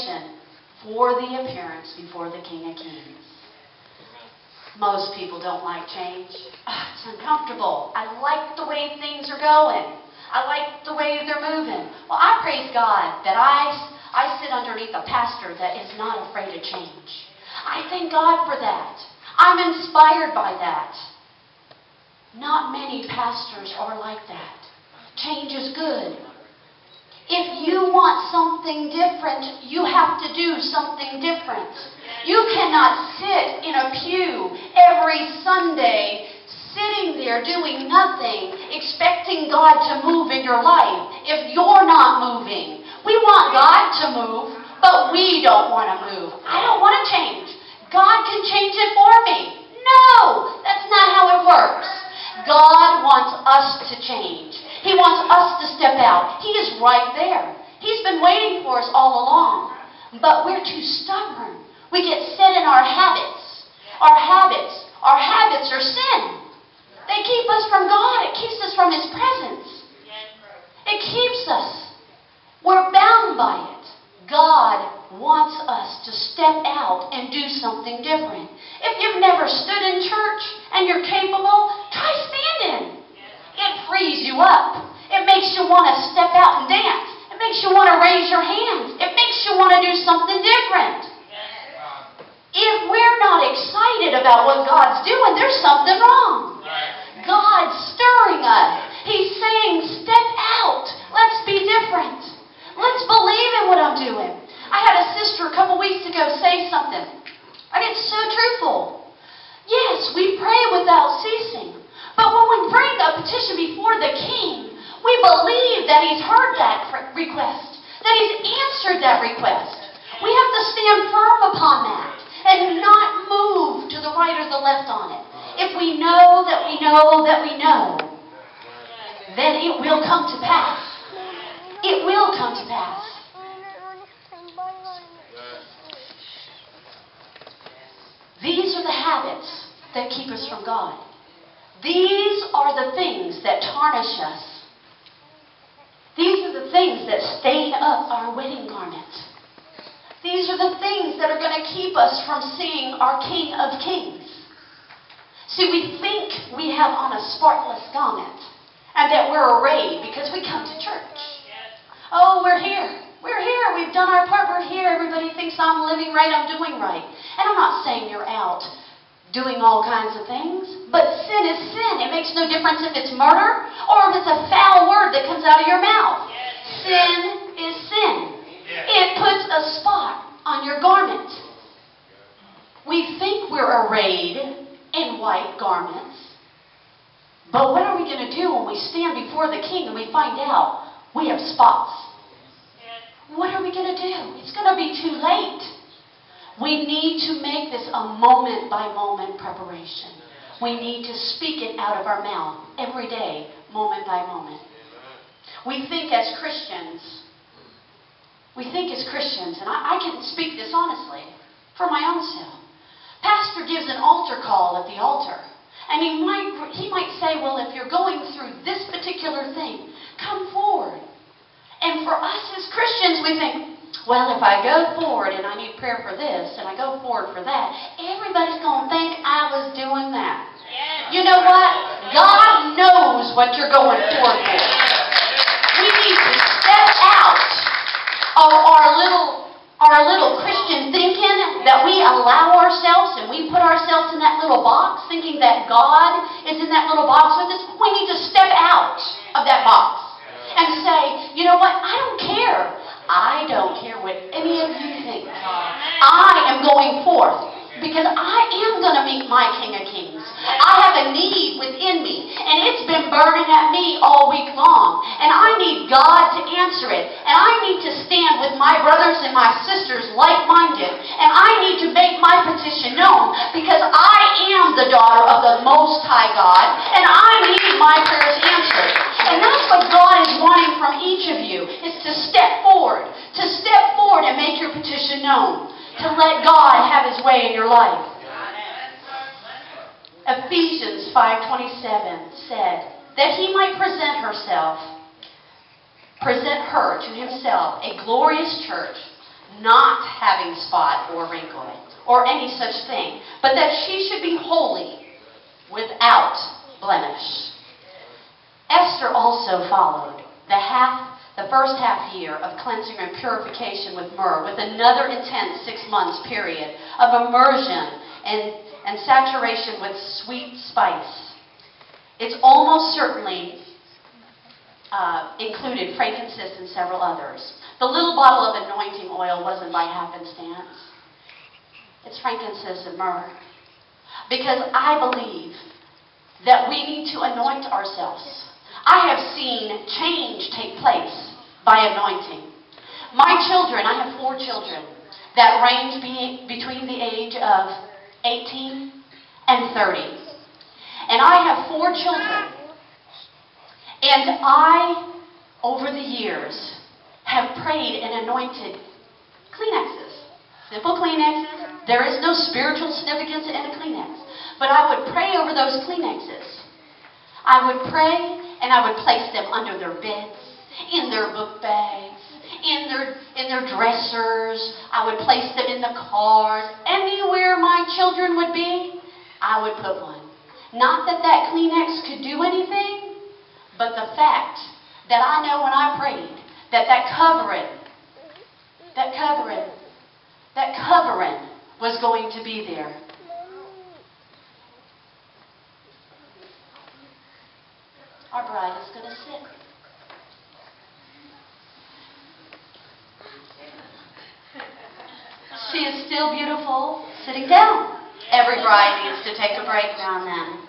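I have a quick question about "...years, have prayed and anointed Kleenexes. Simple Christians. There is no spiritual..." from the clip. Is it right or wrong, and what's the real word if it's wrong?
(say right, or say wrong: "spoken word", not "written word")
wrong: "Kleenexes", not "Christians".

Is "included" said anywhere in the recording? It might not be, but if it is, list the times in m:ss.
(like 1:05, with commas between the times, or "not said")
5:25.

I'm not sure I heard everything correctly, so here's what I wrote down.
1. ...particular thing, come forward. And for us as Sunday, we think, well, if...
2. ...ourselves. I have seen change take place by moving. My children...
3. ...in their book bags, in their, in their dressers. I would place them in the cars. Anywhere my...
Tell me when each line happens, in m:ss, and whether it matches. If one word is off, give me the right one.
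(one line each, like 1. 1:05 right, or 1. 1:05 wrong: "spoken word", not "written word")
1. 3:38 wrong: "Christians", not "Sunday"
2. 5:37 wrong: "anointing", not "moving"
3. 6:10 right.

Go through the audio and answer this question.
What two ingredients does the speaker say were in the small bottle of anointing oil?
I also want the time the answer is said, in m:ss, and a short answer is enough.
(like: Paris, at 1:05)
frankincense and myrrh, at 5:32.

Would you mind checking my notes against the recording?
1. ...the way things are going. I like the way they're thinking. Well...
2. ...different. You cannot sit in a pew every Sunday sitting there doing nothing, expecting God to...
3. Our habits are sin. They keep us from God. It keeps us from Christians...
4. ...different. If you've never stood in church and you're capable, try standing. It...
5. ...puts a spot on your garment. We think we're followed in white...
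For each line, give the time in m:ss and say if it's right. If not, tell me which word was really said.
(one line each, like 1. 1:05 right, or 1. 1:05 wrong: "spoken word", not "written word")
1. 0:08 wrong: "moving", not "thinking"
2. 0:31 right
3. 1:04 wrong: "His", not "Christians"
4. 1:18 right
5. 2:59 wrong: "arrayed", not "followed".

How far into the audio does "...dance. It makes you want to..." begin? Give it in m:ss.
1:26.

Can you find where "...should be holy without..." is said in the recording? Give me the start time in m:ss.
5:04.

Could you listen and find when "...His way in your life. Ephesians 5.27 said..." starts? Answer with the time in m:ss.
4:47.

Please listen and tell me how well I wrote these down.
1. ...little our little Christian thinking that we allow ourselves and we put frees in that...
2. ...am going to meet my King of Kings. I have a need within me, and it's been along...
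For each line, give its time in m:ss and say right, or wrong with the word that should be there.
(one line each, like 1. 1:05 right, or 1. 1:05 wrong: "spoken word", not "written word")
1. 3:58 wrong: "ourselves", not "frees"
2. 4:18 wrong: "burning", not "along".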